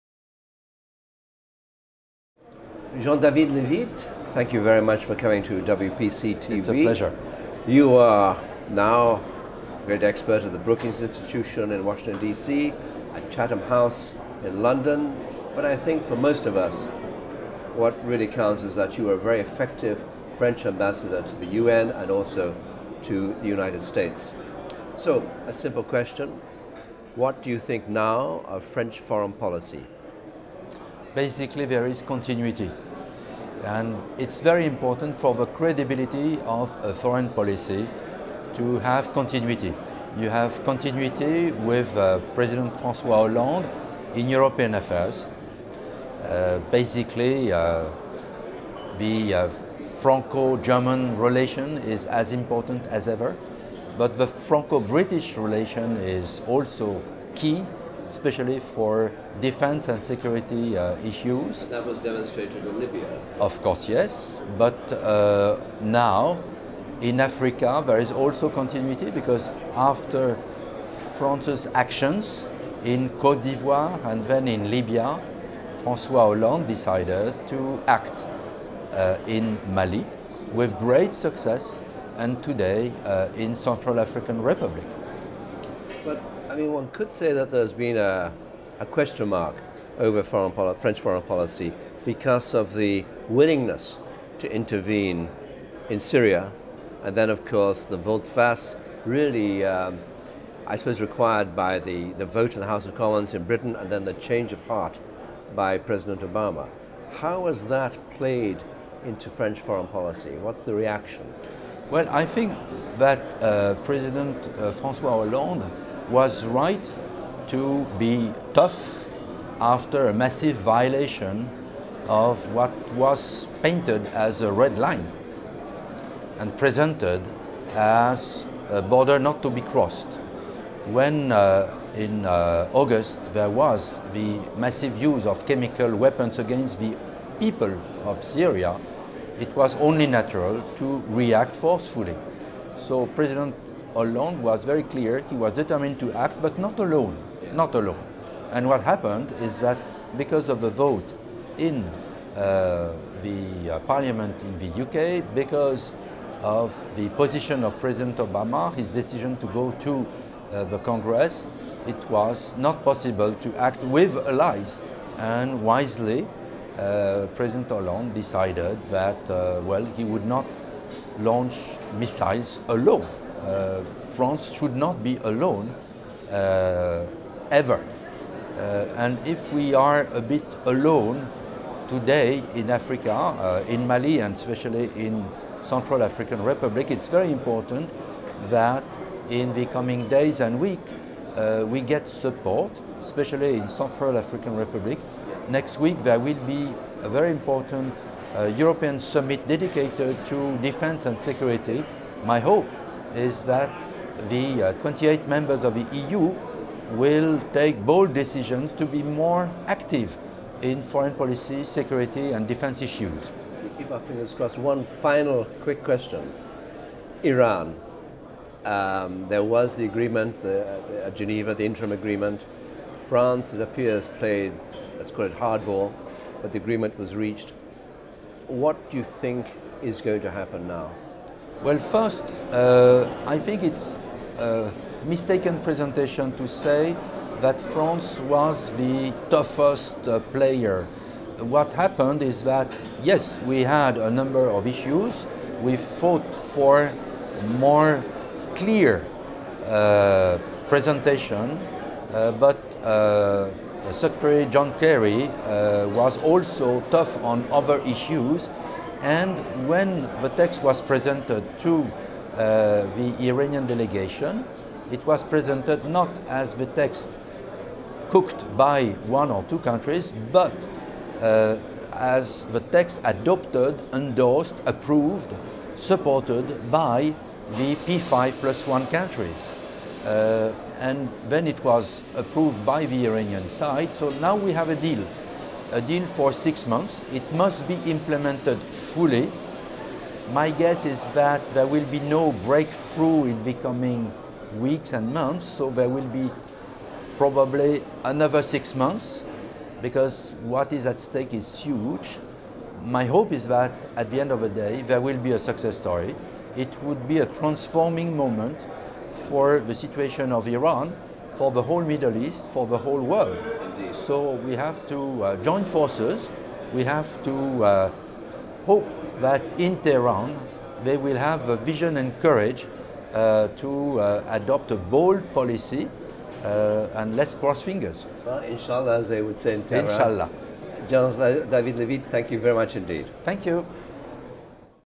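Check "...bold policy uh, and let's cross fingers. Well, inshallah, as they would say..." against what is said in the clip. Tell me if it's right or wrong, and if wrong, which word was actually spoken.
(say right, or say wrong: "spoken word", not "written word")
right.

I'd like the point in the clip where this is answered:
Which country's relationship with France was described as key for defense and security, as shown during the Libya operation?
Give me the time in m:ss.
0:54.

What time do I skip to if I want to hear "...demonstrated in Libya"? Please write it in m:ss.
1:01.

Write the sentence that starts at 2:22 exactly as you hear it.
So President Hollande was very clear, he was determined to act, but not alone, yeah.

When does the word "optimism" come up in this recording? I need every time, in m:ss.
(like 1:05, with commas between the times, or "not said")
not said.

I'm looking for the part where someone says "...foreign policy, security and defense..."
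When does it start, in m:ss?
3:30.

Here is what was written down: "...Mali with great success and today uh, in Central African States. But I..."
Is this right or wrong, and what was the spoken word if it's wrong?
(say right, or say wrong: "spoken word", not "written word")
wrong: "Republic", not "States".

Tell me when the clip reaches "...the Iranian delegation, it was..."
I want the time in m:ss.
4:22.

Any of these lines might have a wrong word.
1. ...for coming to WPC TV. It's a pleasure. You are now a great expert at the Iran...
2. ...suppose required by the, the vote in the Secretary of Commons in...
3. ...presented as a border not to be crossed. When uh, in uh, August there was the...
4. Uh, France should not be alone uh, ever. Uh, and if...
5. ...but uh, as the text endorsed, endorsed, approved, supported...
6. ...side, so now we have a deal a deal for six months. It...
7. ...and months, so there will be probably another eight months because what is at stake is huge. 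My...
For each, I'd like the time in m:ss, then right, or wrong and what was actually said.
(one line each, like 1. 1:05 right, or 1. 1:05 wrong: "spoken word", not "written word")
1. 0:05 wrong: "Brookings", not "Iran"
2. 1:40 wrong: "House", not "Secretary"
3. 2:06 right
4. 2:53 right
5. 4:30 wrong: "adopted", not "endorsed"
6. 4:43 right
7. 4:54 wrong: "six", not "eight".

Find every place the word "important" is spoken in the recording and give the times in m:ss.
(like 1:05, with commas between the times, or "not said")
0:34, 0:52, 3:07, 3:17.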